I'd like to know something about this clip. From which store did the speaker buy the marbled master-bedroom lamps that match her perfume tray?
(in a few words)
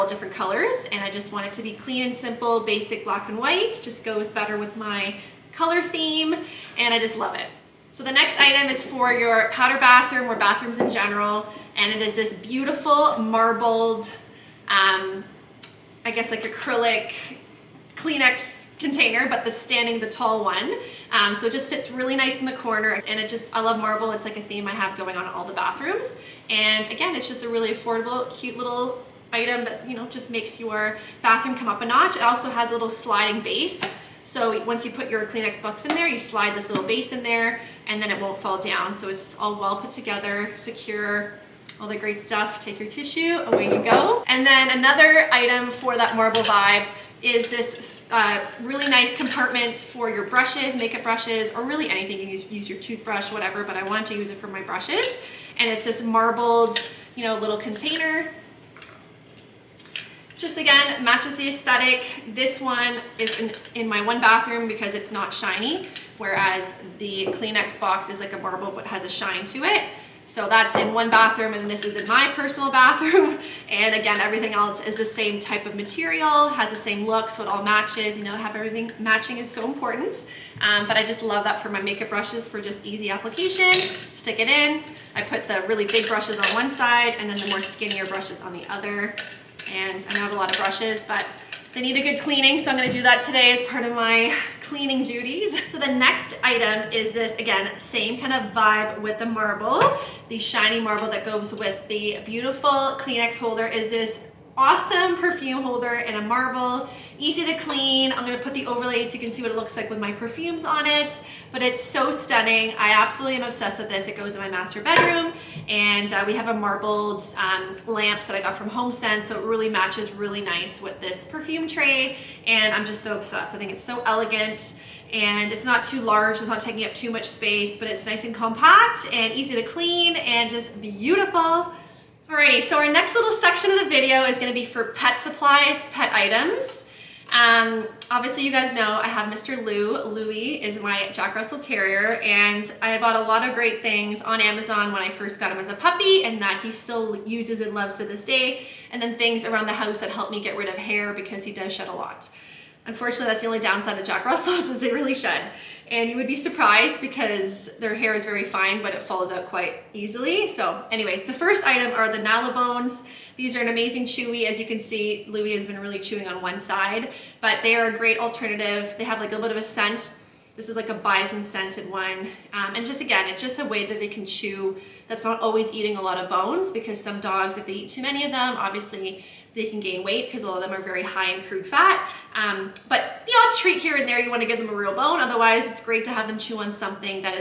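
HomeSense.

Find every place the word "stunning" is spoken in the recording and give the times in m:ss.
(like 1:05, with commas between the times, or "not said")
1:52.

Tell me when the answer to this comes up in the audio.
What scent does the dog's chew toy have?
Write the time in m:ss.
2:50.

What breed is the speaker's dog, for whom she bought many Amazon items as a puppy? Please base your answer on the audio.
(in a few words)
Jack Russell Terrier.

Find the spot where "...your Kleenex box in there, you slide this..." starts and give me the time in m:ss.
0:35.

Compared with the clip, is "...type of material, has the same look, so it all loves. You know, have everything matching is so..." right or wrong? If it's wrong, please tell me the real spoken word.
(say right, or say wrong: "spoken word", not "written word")
wrong: "matches", not "loves".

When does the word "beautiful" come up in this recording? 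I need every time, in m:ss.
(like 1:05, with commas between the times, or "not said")
0:12, 1:42, 2:10.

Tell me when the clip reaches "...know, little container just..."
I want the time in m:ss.
0:57.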